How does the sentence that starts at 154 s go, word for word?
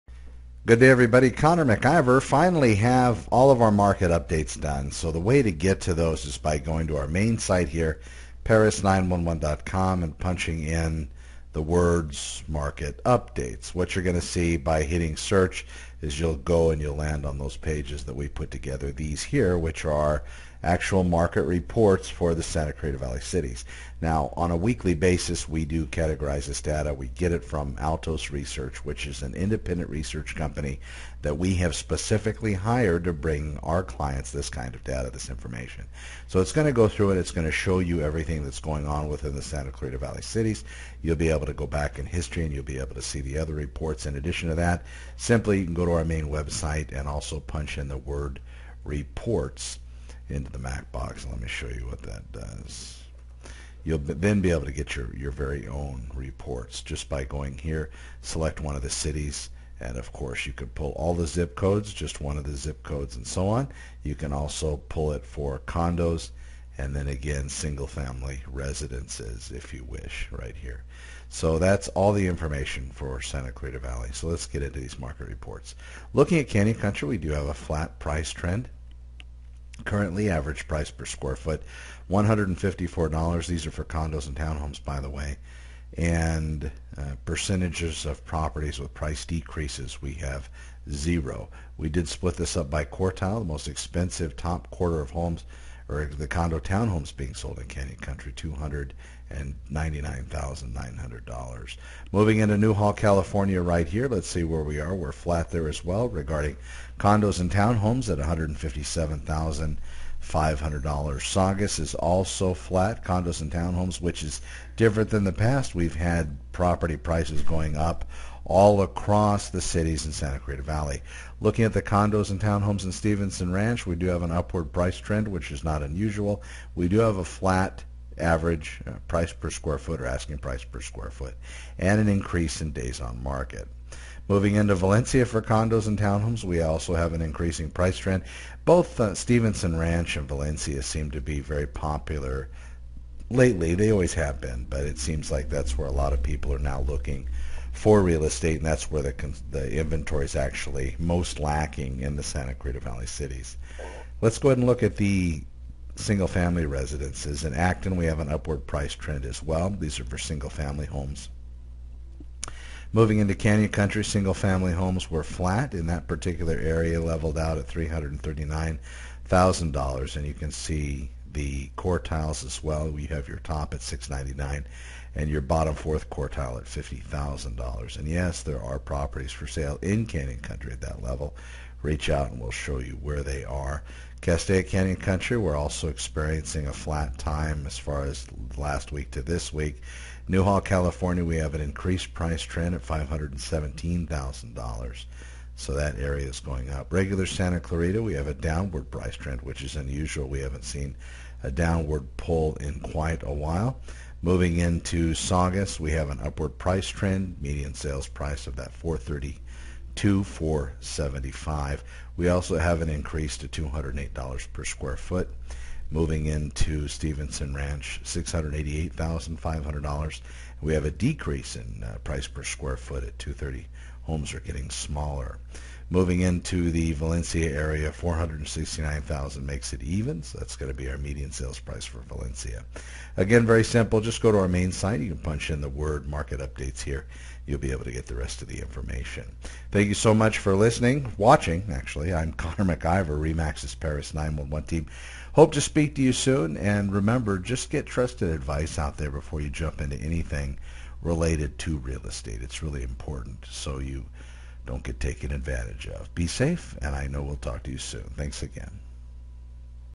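Let's go ahead and look at the single family residences.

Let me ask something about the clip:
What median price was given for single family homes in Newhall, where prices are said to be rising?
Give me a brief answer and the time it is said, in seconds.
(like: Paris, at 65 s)
$517,000, at 192 s.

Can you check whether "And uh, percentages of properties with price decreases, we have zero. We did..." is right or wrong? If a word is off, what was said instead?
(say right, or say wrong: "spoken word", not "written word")
right.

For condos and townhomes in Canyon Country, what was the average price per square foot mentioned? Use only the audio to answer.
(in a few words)
$154.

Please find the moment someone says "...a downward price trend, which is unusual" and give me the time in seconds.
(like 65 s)
198 s.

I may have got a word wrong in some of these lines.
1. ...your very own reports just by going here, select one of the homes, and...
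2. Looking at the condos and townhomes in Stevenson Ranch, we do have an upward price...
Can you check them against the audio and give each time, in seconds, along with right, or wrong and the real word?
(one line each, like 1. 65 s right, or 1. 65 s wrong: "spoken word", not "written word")
1. 55 s wrong: "cities", not "homes"
2. 121 s right.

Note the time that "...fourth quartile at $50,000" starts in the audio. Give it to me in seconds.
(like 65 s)
175 s.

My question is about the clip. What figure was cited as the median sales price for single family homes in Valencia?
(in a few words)
469,000.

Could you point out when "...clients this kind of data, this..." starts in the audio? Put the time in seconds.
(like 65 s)
33 s.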